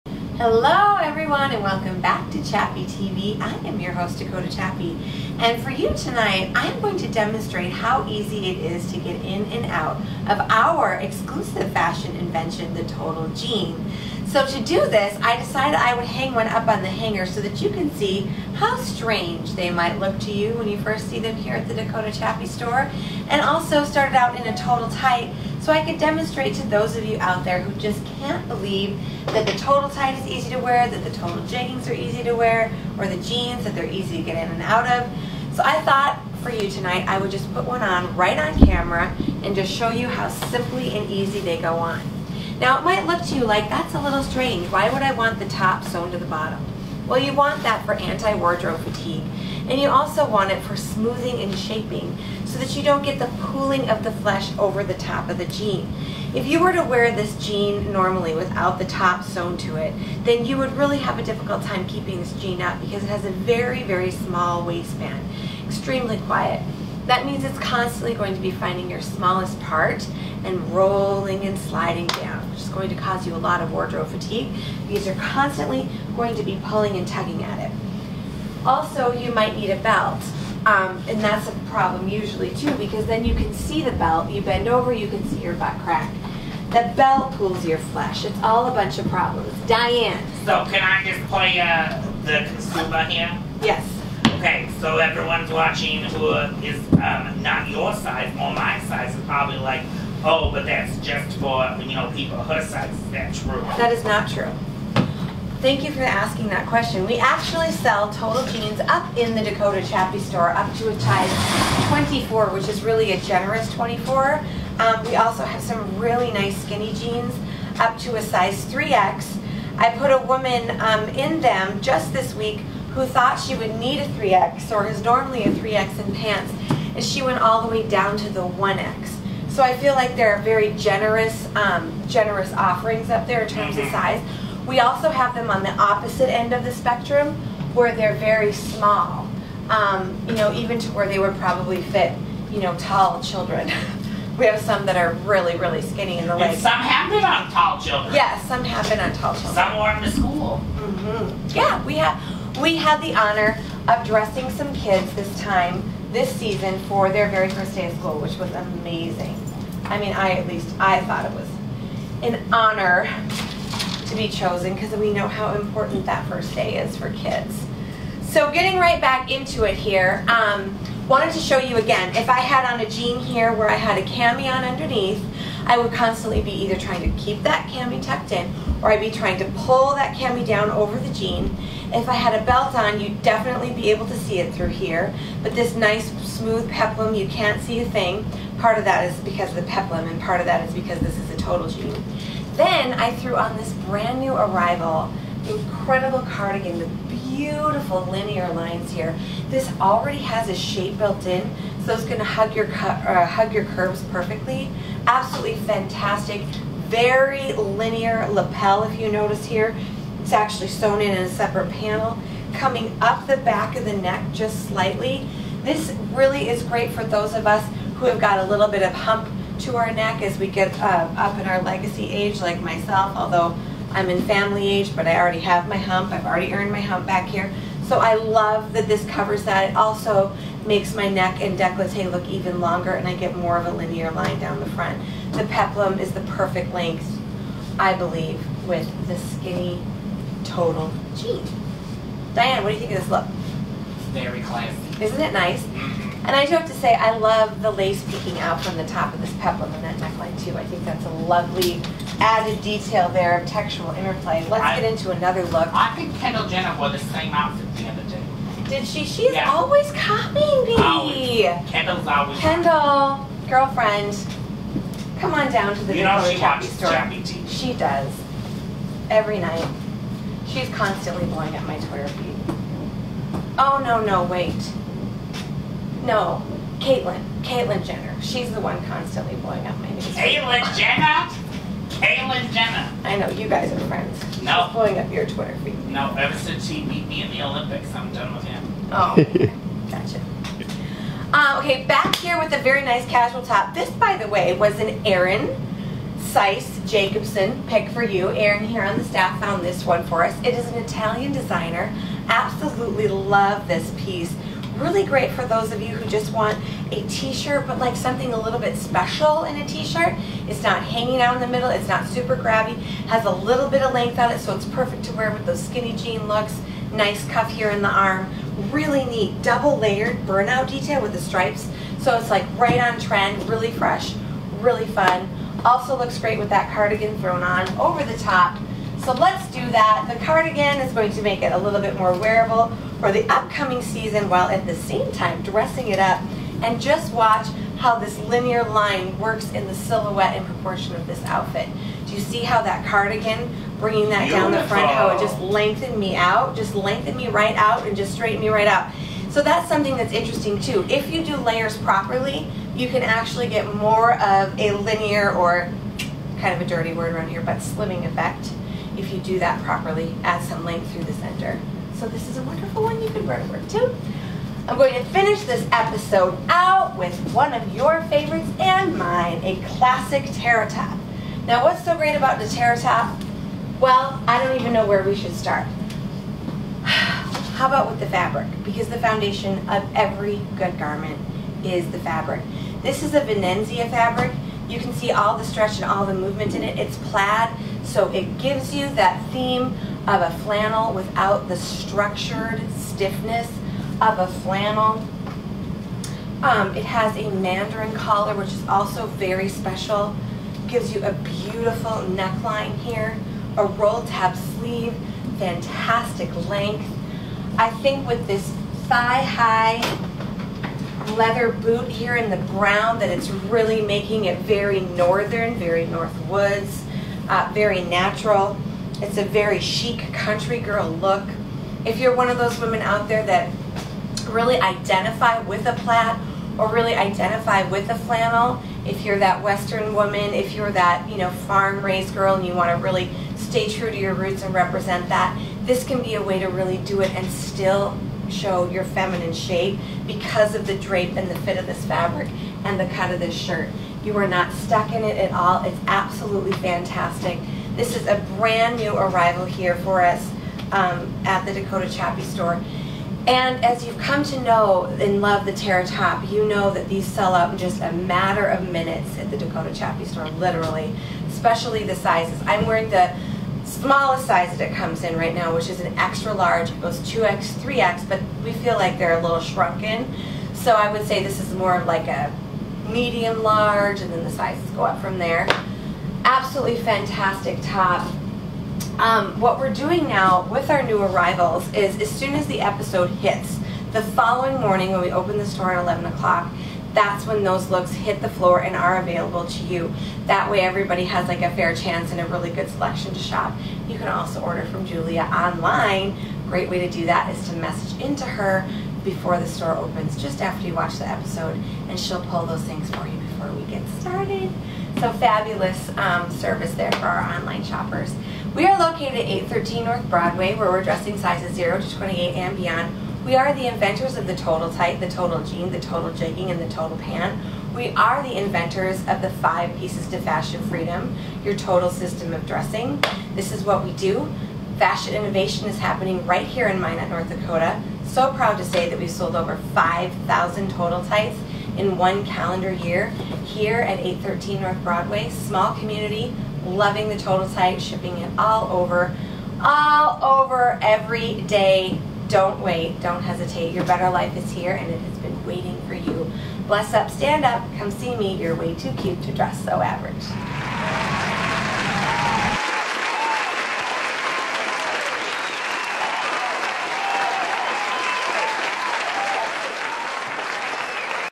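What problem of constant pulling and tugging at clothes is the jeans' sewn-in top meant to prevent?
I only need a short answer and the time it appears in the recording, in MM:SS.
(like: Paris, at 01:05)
wardrobe fatigue, at 00:47.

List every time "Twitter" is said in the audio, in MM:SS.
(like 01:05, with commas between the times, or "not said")
04:31, 04:45.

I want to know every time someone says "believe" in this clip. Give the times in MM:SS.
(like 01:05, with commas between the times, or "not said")
00:28, 03:57.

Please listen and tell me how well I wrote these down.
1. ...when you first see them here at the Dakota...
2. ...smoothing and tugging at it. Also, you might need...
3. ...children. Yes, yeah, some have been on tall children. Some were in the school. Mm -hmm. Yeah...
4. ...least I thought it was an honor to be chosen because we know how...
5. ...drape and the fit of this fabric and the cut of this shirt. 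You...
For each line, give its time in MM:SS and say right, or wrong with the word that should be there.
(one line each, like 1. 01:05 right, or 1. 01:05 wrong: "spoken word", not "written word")
1. 00:20 right
2. 01:16 wrong: "pulling", not "smoothing"
3. 02:27 right
4. 02:40 right
5. 07:20 right.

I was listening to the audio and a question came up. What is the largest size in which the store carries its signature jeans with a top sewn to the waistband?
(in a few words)
24.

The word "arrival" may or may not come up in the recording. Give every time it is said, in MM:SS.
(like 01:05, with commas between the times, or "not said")
03:14, 07:28, 08:01.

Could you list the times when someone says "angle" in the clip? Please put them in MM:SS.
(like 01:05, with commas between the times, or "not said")
not said.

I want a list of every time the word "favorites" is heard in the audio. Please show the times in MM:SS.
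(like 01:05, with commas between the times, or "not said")
06:08.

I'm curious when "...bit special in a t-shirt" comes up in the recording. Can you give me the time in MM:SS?
05:08.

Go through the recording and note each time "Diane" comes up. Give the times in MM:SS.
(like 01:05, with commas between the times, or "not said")
01:29, 04:02.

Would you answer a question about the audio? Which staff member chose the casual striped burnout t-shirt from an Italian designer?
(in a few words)
Aaron Seiss Jacobson.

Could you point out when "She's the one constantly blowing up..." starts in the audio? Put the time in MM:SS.
04:38.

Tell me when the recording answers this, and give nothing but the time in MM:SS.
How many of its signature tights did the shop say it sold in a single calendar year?
08:49.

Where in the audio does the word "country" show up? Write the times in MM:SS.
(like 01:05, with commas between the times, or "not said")
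07:00.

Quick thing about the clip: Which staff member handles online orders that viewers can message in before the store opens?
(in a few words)
Julia.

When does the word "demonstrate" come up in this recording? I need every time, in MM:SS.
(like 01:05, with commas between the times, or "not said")
00:07, 00:25.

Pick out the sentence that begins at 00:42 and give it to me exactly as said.
Now it might look to you like, that's a little strange.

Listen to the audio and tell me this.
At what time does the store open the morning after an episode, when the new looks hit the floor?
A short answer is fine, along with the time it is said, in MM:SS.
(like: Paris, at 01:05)
11 o'clock, at 08:05.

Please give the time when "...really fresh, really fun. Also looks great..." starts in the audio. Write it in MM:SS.
05:23.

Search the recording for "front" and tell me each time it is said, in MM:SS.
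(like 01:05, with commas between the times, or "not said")
03:54, 05:44.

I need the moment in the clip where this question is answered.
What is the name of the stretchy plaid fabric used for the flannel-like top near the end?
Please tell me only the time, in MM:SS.
06:23.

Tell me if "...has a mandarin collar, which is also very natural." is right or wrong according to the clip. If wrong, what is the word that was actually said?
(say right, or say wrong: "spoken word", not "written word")
wrong: "special", not "natural".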